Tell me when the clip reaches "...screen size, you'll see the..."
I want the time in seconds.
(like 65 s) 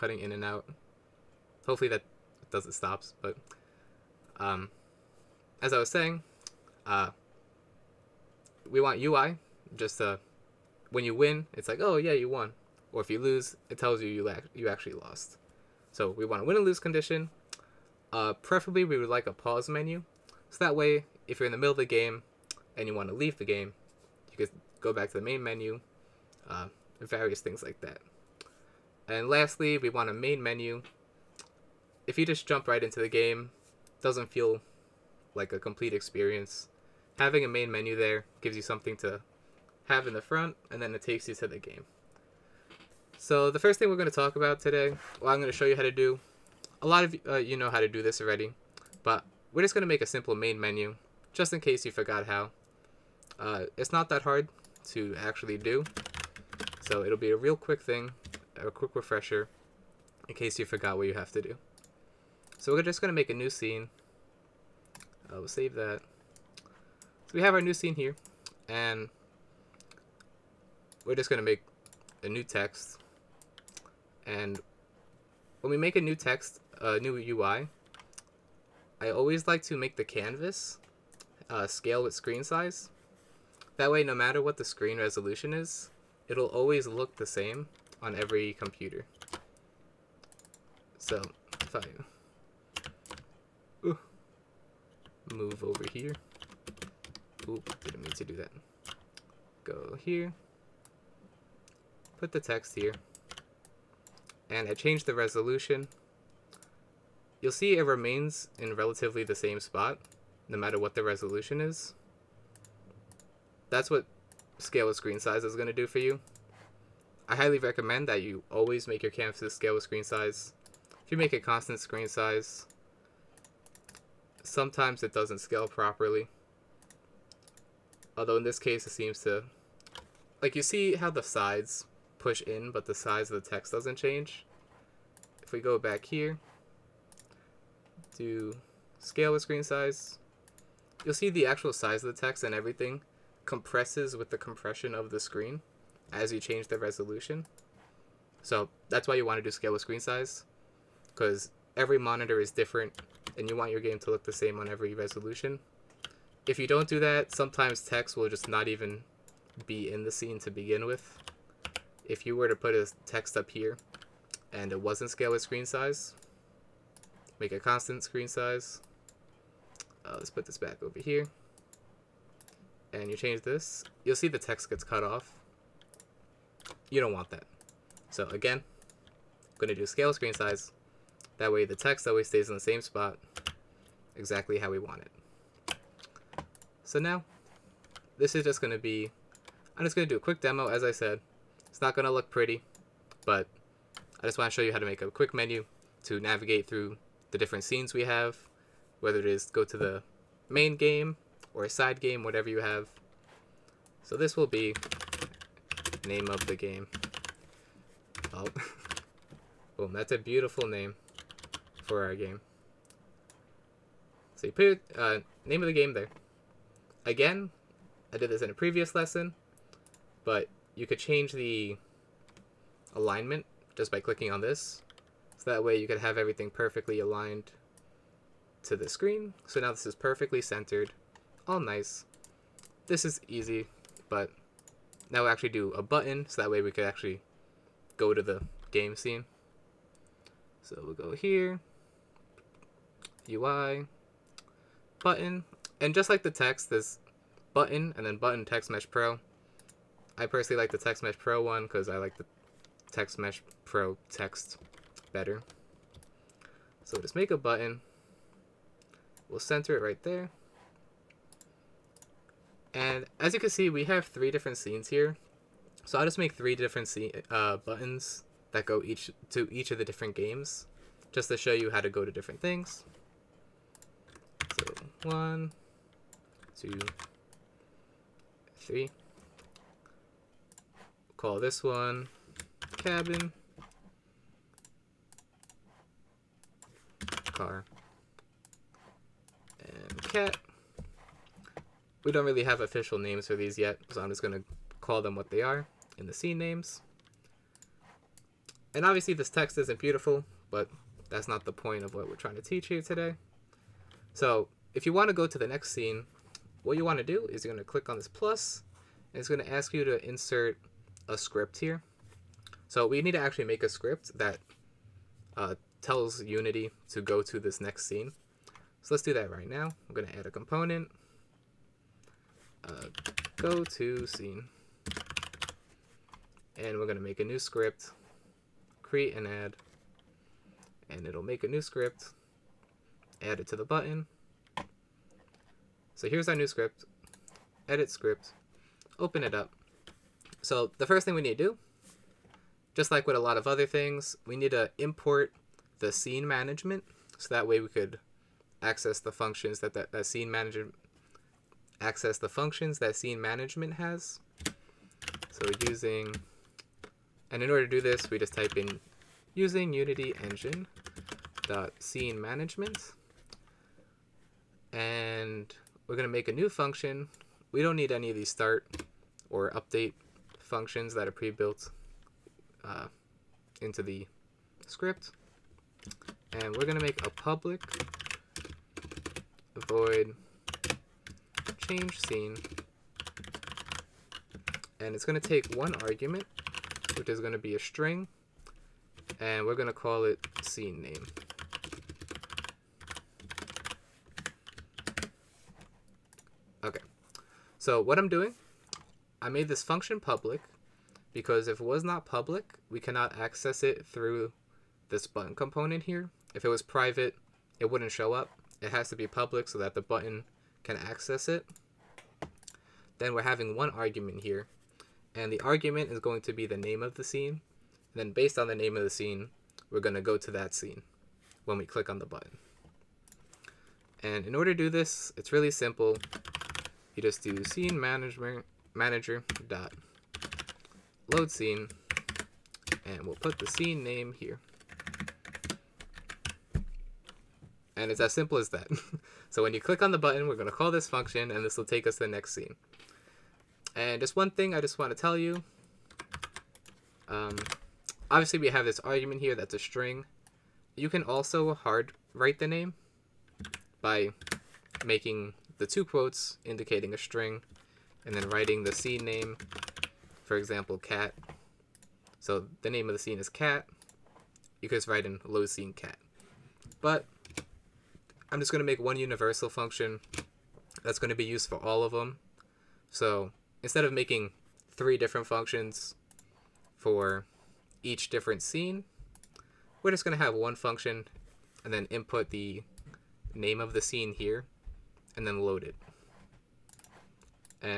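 139 s.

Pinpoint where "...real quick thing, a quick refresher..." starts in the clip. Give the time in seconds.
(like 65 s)
57 s.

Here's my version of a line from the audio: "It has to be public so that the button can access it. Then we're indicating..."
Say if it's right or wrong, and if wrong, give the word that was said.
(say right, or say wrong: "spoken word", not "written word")
wrong: "having", not "indicating".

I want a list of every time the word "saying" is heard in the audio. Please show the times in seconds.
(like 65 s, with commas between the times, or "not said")
5 s.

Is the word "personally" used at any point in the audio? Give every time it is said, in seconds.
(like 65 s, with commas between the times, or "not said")
250 s.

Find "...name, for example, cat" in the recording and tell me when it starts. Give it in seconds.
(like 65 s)
459 s.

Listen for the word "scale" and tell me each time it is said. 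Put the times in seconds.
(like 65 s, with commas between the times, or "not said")
81 s, 114 s, 119 s, 125 s, 138 s, 149 s, 165 s, 179 s.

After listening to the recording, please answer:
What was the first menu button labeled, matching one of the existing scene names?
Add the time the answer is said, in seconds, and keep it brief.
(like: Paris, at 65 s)
Cabin, at 282 s.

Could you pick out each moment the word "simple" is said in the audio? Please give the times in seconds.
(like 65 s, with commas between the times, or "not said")
50 s, 425 s, 438 s.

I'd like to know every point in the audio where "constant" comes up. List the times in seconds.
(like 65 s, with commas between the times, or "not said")
121 s, 167 s.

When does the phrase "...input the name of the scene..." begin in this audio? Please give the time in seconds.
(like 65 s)
481 s.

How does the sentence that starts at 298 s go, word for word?
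And obviously this text isn't beautiful, but that's not the point of what we're trying to teach you today.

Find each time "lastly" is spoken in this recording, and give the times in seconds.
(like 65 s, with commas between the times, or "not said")
29 s.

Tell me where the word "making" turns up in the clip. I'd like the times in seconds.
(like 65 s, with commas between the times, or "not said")
454 s, 473 s.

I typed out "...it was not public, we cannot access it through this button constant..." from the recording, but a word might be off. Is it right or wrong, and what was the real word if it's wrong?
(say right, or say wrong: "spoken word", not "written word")
wrong: "component", not "constant".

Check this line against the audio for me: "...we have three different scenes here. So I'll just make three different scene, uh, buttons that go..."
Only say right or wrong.
right.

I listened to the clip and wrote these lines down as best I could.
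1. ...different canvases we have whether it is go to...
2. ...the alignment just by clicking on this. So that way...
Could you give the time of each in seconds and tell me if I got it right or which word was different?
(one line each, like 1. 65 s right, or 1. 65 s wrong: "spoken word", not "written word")
1. 197 s wrong: "scenes", not "canvases"
2. 221 s right.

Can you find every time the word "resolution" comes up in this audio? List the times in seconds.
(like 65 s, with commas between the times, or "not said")
84 s, 105 s, 111 s, 146 s, 154 s.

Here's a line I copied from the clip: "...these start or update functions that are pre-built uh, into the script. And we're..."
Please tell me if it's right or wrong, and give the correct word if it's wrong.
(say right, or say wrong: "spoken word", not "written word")
right.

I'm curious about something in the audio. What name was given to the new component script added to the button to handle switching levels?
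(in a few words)
Go to scene.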